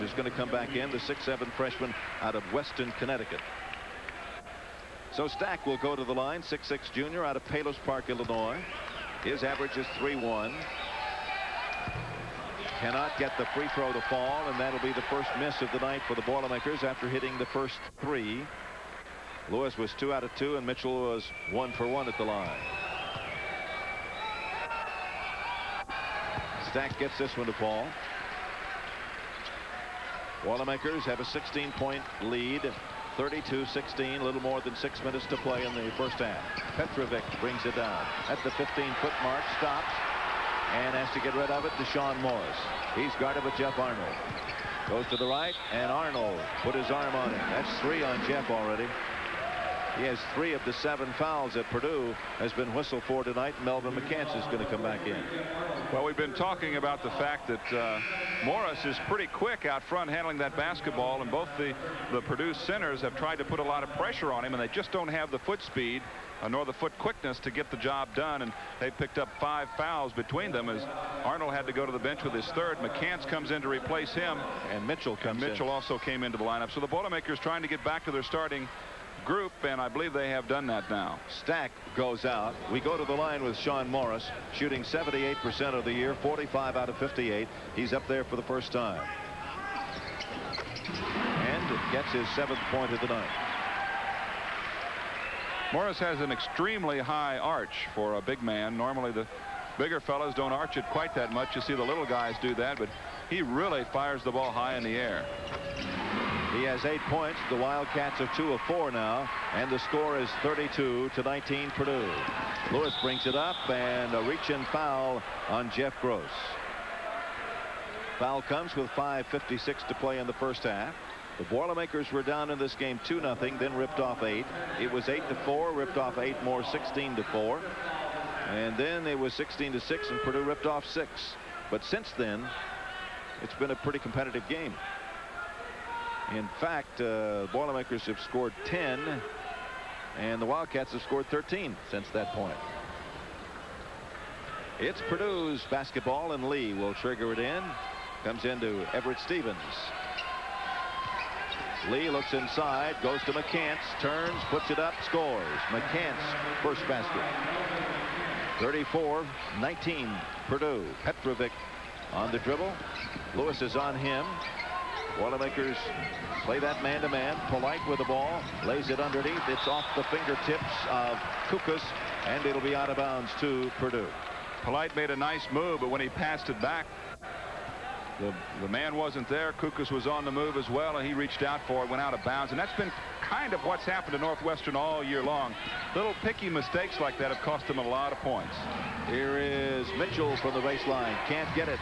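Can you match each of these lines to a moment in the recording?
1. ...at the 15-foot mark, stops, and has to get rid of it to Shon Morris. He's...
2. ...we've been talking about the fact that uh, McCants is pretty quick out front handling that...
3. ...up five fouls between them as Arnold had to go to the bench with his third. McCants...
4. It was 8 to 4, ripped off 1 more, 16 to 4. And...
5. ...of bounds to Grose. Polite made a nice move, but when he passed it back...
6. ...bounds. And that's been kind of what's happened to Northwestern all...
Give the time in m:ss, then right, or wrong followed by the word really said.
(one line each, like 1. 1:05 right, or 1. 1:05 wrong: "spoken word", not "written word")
1. 0:38 right
2. 0:56 wrong: "Morris", not "McCants"
3. 1:09 right
4. 2:04 wrong: "8", not "1"
5. 2:52 wrong: "Purdue", not "Grose"
6. 3:02 right.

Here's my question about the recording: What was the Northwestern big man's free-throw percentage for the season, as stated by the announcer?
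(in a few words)
78%.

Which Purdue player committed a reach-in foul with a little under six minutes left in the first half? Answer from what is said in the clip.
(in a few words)
Jeff Grose.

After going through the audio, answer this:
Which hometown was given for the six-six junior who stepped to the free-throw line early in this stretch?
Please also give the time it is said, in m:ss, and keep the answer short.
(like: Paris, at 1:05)
Palos Park, Illinois, at 0:07.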